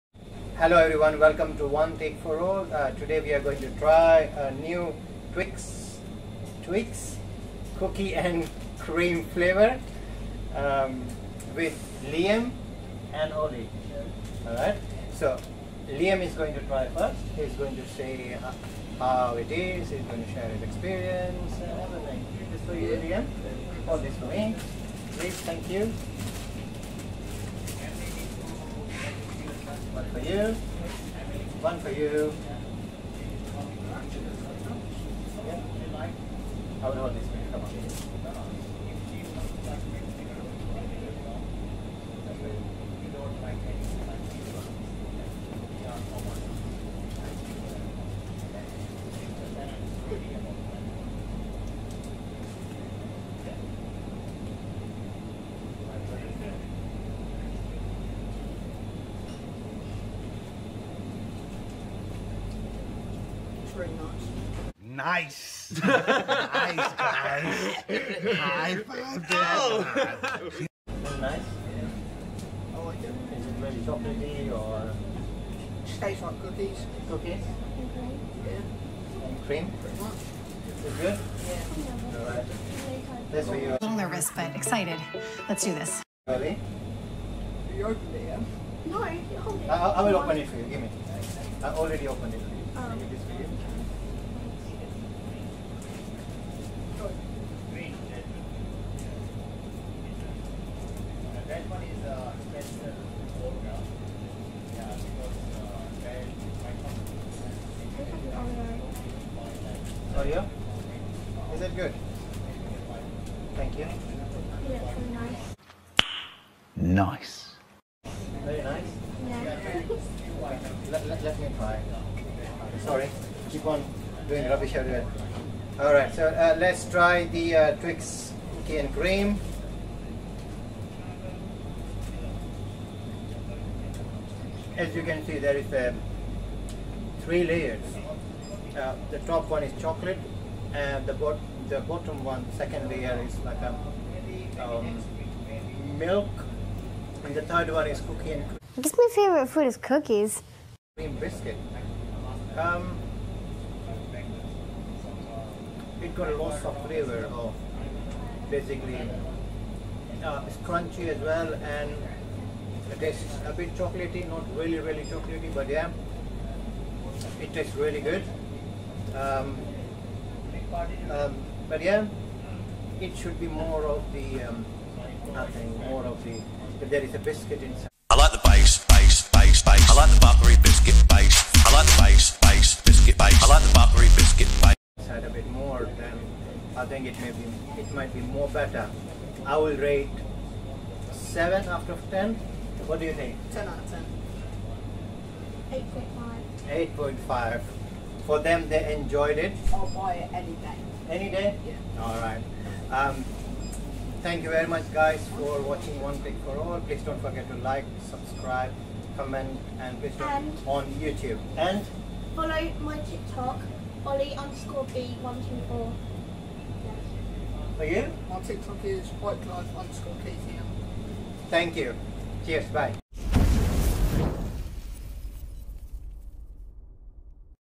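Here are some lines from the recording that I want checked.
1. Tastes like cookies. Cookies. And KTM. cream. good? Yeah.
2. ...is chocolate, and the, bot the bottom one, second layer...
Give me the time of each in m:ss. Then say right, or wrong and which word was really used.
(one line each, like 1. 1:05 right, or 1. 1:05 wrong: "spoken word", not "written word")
1. 1:15 wrong: "Yeah", not "KTM"
2. 2:19 right.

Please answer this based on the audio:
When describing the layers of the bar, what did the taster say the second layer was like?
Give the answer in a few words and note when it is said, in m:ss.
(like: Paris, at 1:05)
Milk, at 2:25.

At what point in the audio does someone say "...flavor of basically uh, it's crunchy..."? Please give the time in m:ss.
2:36.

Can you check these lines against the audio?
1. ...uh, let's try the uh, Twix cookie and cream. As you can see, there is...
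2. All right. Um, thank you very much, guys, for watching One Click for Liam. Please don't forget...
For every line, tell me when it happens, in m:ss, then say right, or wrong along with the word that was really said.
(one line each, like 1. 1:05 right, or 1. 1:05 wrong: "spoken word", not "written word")
1. 2:06 right
2. 3:22 wrong: "All", not "Liam".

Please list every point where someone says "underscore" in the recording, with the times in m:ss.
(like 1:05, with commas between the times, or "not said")
3:34, 3:39.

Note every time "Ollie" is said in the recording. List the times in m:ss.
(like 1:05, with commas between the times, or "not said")
0:13, 3:34.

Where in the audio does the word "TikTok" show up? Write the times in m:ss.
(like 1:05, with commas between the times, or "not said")
3:32, 3:38.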